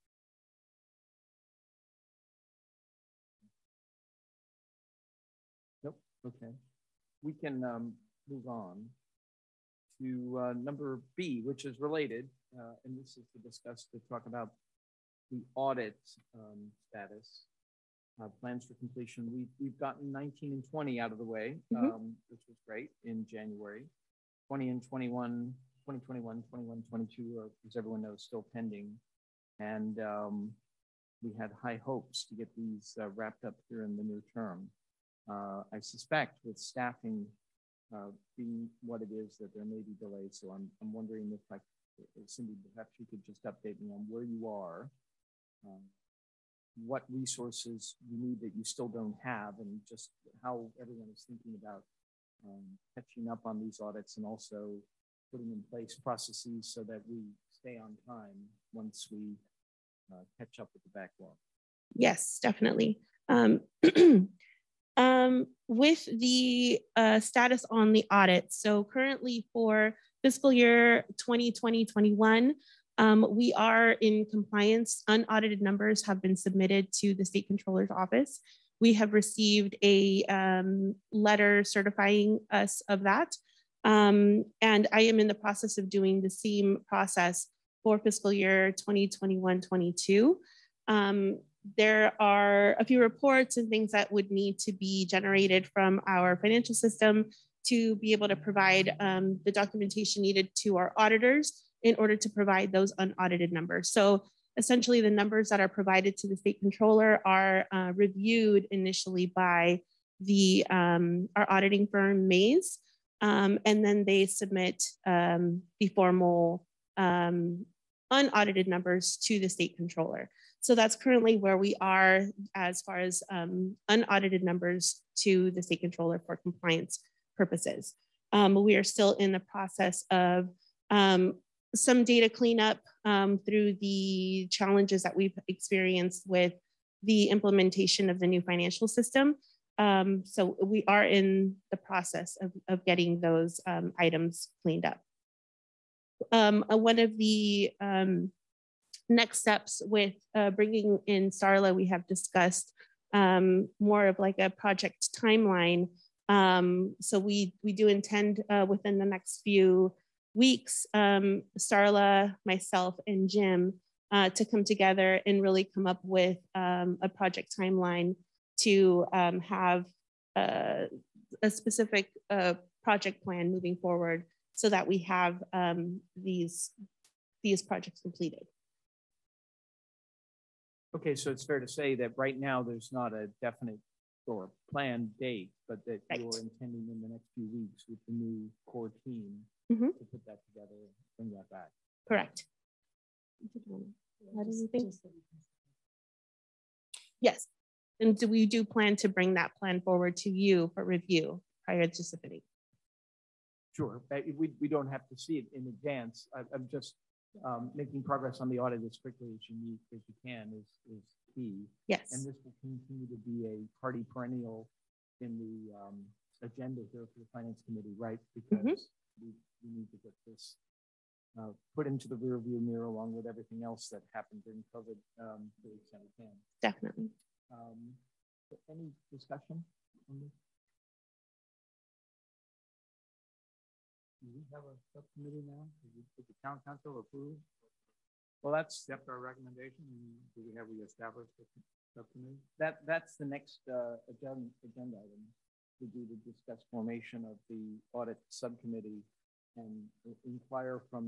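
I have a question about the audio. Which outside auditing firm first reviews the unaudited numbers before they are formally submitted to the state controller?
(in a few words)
Maze.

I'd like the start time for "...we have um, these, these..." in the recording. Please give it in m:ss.
2:54.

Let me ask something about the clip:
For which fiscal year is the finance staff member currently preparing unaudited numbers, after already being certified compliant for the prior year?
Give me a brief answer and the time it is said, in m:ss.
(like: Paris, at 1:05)
2021-22, at 1:27.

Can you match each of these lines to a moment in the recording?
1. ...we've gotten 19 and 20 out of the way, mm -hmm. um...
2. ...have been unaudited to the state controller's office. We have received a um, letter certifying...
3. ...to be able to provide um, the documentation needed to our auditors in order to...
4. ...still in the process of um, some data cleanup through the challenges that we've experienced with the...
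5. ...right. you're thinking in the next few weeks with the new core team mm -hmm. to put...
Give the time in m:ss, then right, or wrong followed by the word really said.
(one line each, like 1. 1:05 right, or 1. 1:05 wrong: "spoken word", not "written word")
1. 0:19 right
2. 1:16 wrong: "submitted", not "unaudited"
3. 1:37 right
4. 2:08 right
5. 3:06 wrong: "intending", not "thinking".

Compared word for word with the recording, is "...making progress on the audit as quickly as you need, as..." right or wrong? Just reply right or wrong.
right.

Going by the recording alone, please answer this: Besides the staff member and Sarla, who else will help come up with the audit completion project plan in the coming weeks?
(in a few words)
Jim.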